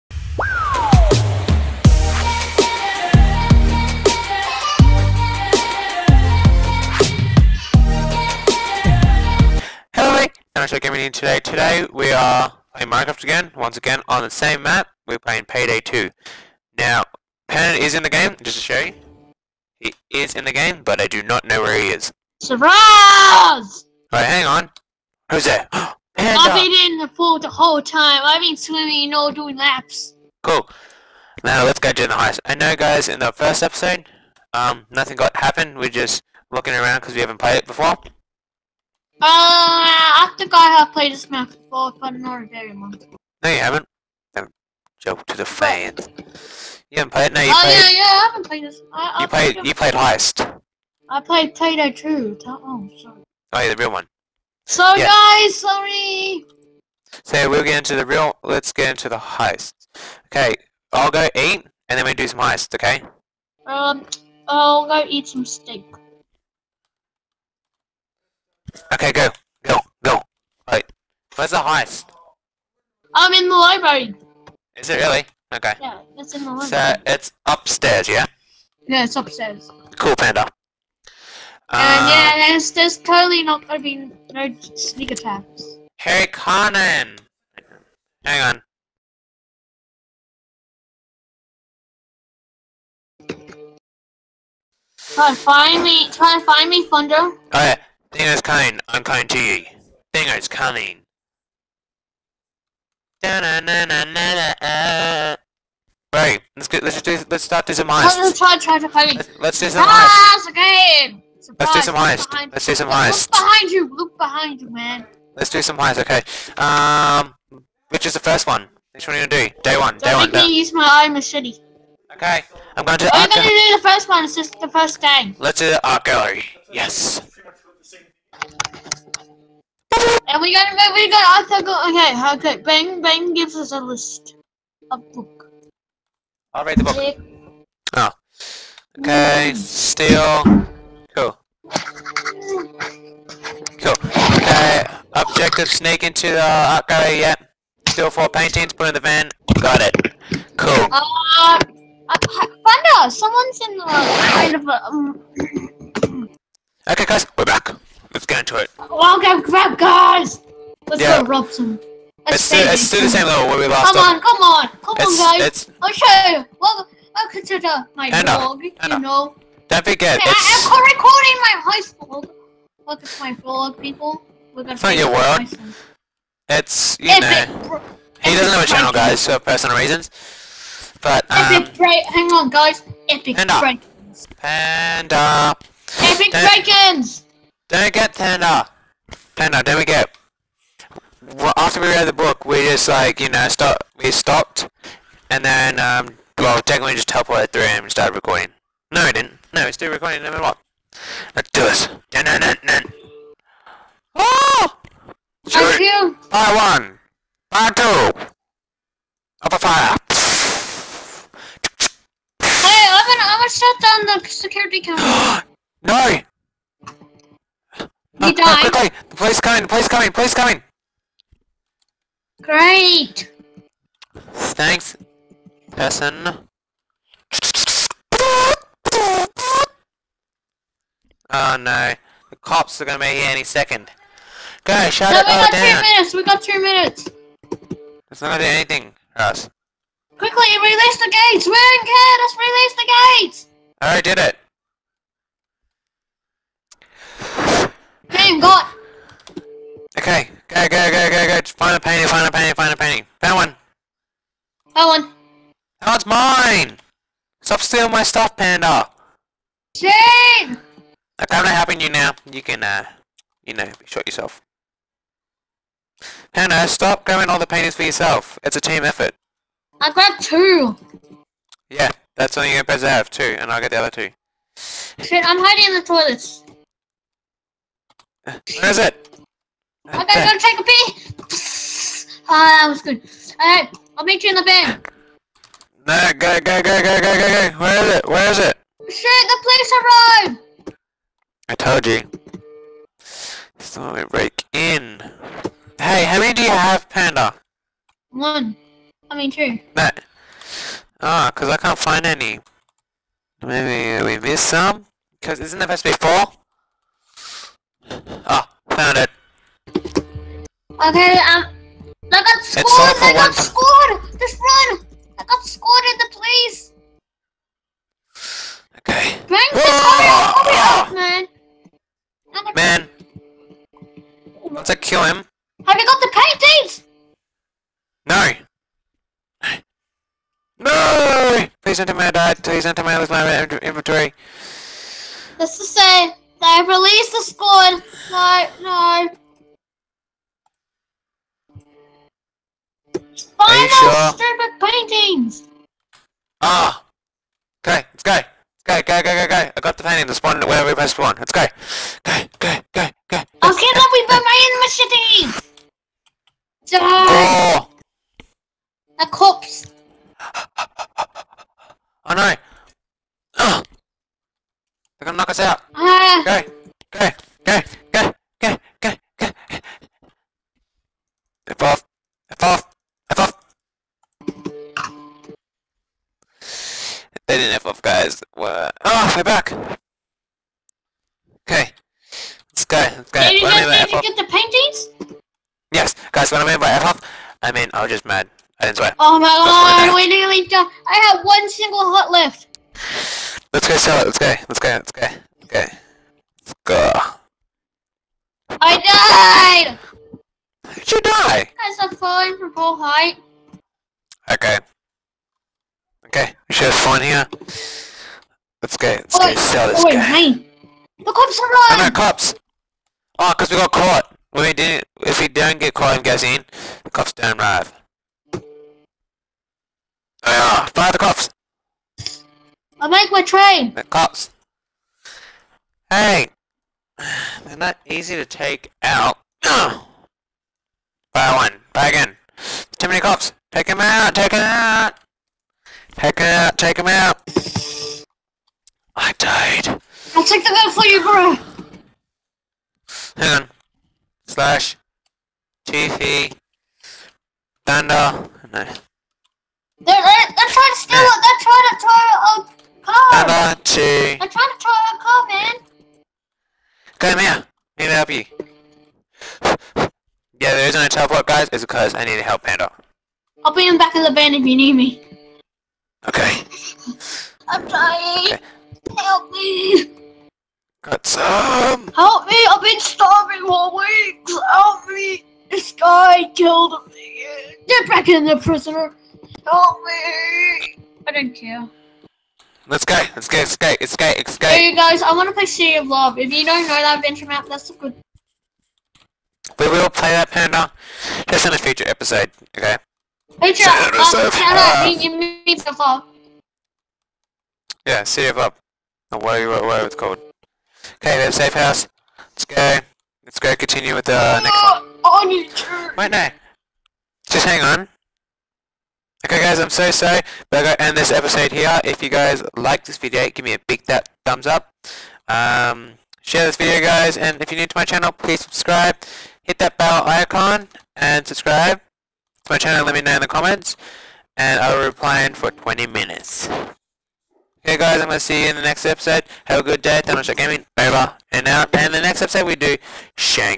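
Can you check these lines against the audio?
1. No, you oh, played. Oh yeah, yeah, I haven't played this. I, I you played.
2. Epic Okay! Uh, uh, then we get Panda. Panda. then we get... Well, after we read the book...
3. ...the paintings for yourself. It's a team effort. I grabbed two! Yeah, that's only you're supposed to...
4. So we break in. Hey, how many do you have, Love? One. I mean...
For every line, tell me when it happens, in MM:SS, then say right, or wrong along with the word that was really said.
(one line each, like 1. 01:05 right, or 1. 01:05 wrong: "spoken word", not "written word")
1. 00:47 right
2. 03:06 wrong: "Breakins", not "Okay"
3. 04:27 right
4. 04:53 wrong: "Panda", not "Love".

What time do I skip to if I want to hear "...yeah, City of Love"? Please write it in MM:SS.
08:17.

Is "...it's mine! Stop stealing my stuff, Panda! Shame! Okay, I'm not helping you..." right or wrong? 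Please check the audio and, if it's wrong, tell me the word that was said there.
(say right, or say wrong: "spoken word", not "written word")
right.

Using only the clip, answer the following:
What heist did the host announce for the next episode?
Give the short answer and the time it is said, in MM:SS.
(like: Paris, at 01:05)
Shank, at 08:53.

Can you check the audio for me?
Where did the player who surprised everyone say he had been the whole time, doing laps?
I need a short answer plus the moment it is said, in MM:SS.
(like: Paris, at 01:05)
the pool, at 00:26.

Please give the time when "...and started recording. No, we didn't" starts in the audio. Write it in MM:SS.
03:17.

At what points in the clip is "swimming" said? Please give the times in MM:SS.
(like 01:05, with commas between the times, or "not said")
00:28.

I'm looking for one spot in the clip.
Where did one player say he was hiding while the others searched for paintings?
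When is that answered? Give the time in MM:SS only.
04:35.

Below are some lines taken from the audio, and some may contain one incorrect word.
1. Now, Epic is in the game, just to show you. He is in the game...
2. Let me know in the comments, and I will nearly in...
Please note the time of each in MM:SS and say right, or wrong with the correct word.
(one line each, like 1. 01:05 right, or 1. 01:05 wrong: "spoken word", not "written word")
1. 00:16 wrong: "Pennant", not "Epic"
2. 08:42 wrong: "reply", not "nearly".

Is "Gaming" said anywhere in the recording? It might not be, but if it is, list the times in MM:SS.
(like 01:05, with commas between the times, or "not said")
00:10, 08:50.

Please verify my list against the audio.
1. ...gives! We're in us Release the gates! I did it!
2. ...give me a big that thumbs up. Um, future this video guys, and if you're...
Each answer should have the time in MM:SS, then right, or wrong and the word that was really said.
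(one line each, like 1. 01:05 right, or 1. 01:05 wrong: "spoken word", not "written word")
1. 04:01 wrong: "gates", not "gives"
2. 08:33 wrong: "share", not "future".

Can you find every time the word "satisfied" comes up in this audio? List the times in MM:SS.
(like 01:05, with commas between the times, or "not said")
not said.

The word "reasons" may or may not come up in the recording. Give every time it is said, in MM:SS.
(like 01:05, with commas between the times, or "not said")
02:59, 07:40.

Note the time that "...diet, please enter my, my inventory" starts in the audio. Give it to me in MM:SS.
05:32.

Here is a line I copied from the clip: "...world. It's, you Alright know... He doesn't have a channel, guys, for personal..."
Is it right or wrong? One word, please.
wrong.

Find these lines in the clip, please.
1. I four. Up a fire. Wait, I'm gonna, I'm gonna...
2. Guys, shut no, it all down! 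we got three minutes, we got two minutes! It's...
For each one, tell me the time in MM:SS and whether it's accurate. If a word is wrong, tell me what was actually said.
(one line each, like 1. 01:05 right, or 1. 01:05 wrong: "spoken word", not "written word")
1. 03:27 wrong: "two", not "four"
2. 03:54 right.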